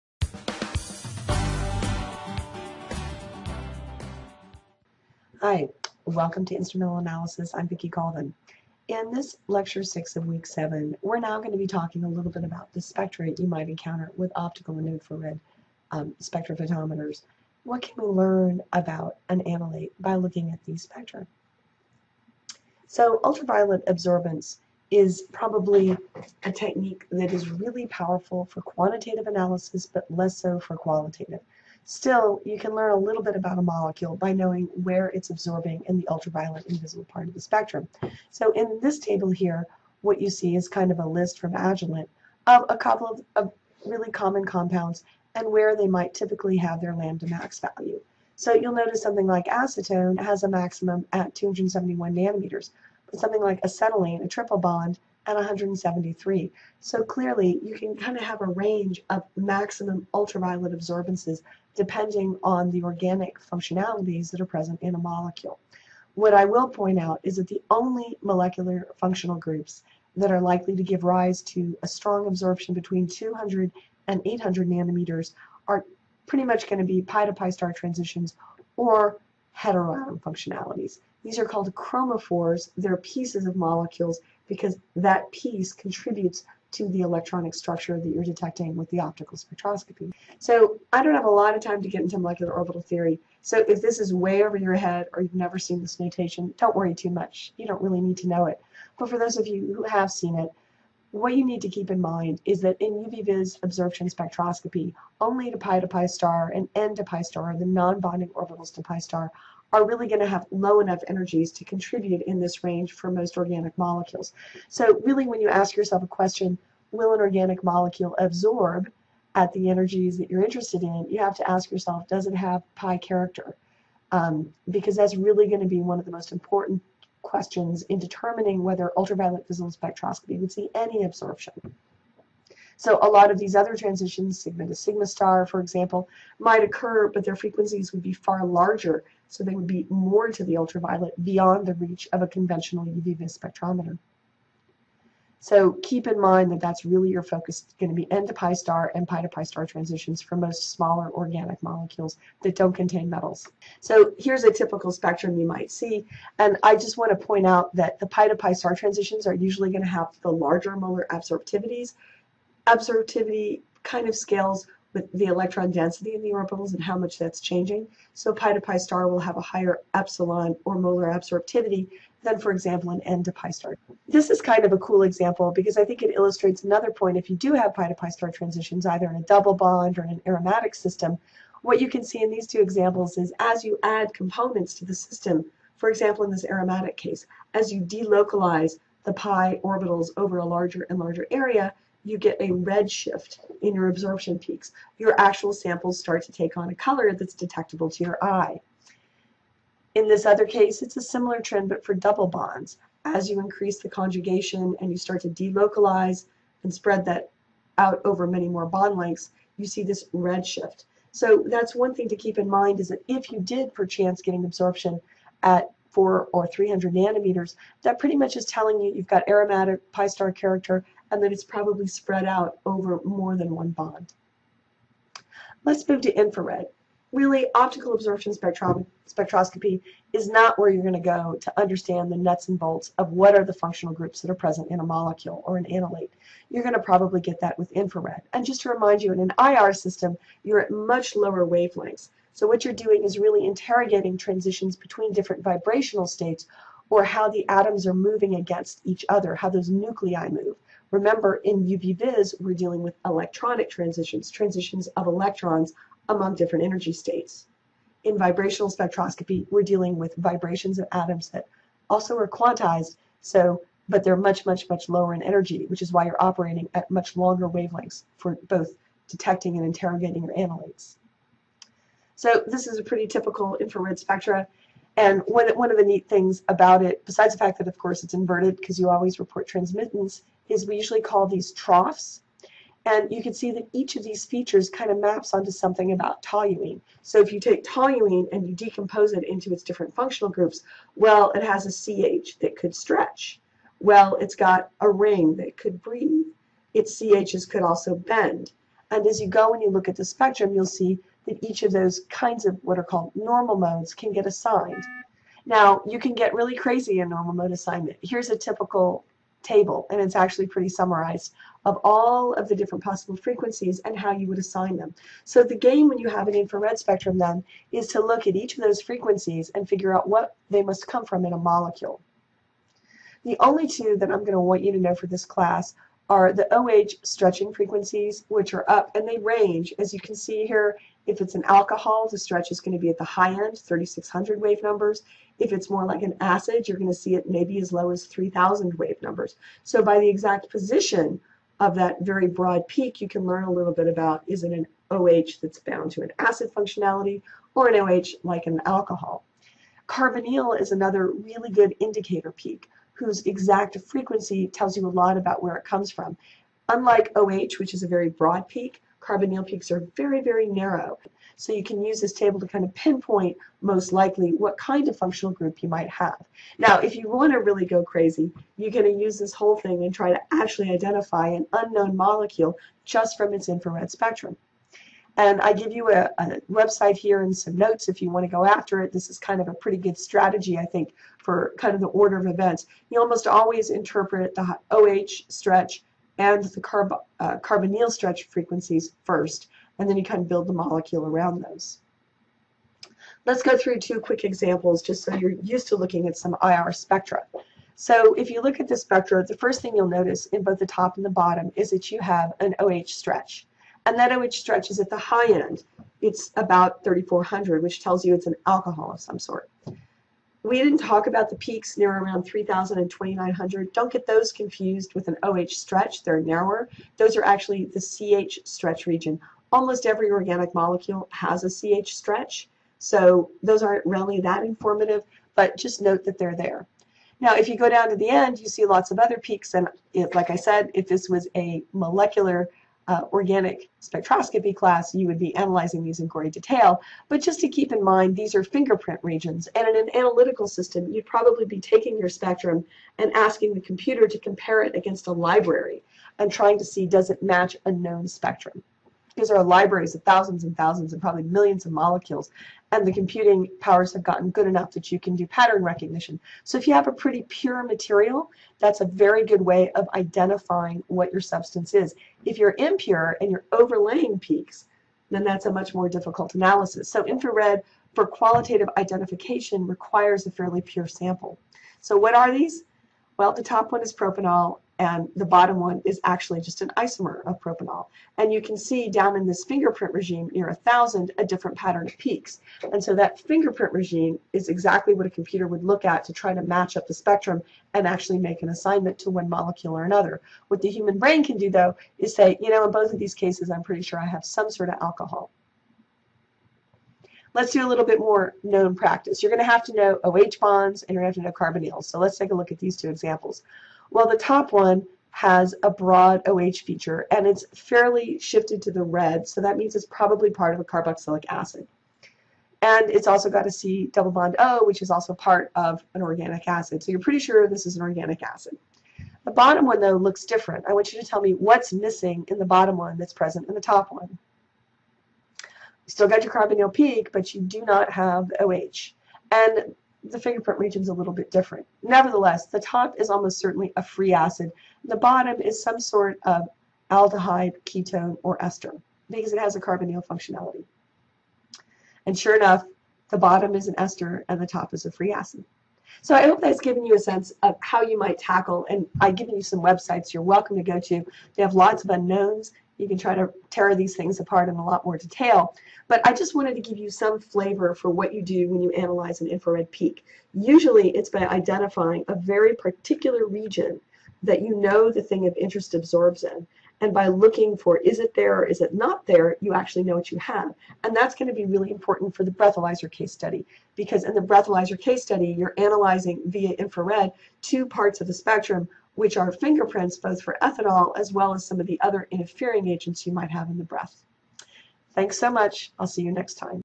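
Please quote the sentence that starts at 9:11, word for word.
They have lots of unknowns you can try to tear these things apart in a lot more detail.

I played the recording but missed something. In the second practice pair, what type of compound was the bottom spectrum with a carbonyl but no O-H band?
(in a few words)
An ester.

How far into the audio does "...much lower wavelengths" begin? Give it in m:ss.
4:00.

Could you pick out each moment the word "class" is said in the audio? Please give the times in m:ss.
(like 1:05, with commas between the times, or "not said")
5:25, 7:14.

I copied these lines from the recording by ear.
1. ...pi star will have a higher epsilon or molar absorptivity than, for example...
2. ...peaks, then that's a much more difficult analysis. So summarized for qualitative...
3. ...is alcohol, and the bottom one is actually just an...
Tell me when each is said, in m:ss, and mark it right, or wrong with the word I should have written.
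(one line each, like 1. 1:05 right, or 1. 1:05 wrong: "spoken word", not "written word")
1. 2:48 right
2. 7:44 wrong: "infrared", not "summarized"
3. 7:53 wrong: "propanol", not "alcohol".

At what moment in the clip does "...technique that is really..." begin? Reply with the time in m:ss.
0:26.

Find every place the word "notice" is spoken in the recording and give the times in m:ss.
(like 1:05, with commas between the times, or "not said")
0:48, 6:39.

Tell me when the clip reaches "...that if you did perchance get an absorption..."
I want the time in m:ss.
3:32.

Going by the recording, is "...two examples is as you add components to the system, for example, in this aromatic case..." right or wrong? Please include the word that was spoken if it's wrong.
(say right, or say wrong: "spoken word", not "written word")
right.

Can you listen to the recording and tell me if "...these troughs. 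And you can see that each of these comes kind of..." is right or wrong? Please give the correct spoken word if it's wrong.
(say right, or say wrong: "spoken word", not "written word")
wrong: "features", not "comes".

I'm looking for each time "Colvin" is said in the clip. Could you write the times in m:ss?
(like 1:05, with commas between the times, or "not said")
0:07.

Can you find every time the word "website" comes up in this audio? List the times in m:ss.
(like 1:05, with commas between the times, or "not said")
6:16, 9:09.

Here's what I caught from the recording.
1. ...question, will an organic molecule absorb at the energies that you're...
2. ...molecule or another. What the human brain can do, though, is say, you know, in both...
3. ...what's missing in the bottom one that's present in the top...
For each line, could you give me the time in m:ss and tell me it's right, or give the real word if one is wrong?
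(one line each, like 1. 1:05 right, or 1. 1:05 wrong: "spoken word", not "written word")
1. 1:56 right
2. 8:09 right
3. 8:41 right.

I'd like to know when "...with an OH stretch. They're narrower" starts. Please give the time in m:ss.
6:54.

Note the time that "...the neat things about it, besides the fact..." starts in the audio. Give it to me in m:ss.
4:35.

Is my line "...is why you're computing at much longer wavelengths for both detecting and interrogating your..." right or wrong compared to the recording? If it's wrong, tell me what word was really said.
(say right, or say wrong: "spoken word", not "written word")
wrong: "operating", not "computing".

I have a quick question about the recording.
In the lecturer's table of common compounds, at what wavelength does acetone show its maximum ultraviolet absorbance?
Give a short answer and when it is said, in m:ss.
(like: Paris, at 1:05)
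271 nanometers, at 0:51.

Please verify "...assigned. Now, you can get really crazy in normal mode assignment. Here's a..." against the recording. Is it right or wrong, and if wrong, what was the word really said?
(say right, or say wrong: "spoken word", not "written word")
right.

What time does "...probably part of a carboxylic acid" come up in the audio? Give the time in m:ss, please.
8:29.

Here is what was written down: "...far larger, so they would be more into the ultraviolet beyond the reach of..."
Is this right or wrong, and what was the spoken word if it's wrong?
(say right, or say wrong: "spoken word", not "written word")
right.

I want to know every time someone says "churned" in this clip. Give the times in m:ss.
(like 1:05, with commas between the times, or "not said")
not said.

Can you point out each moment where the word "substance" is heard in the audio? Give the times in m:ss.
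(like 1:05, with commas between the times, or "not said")
7:41.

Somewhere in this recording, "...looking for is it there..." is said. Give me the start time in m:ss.
9:27.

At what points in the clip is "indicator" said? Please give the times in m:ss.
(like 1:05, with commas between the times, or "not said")
5:51.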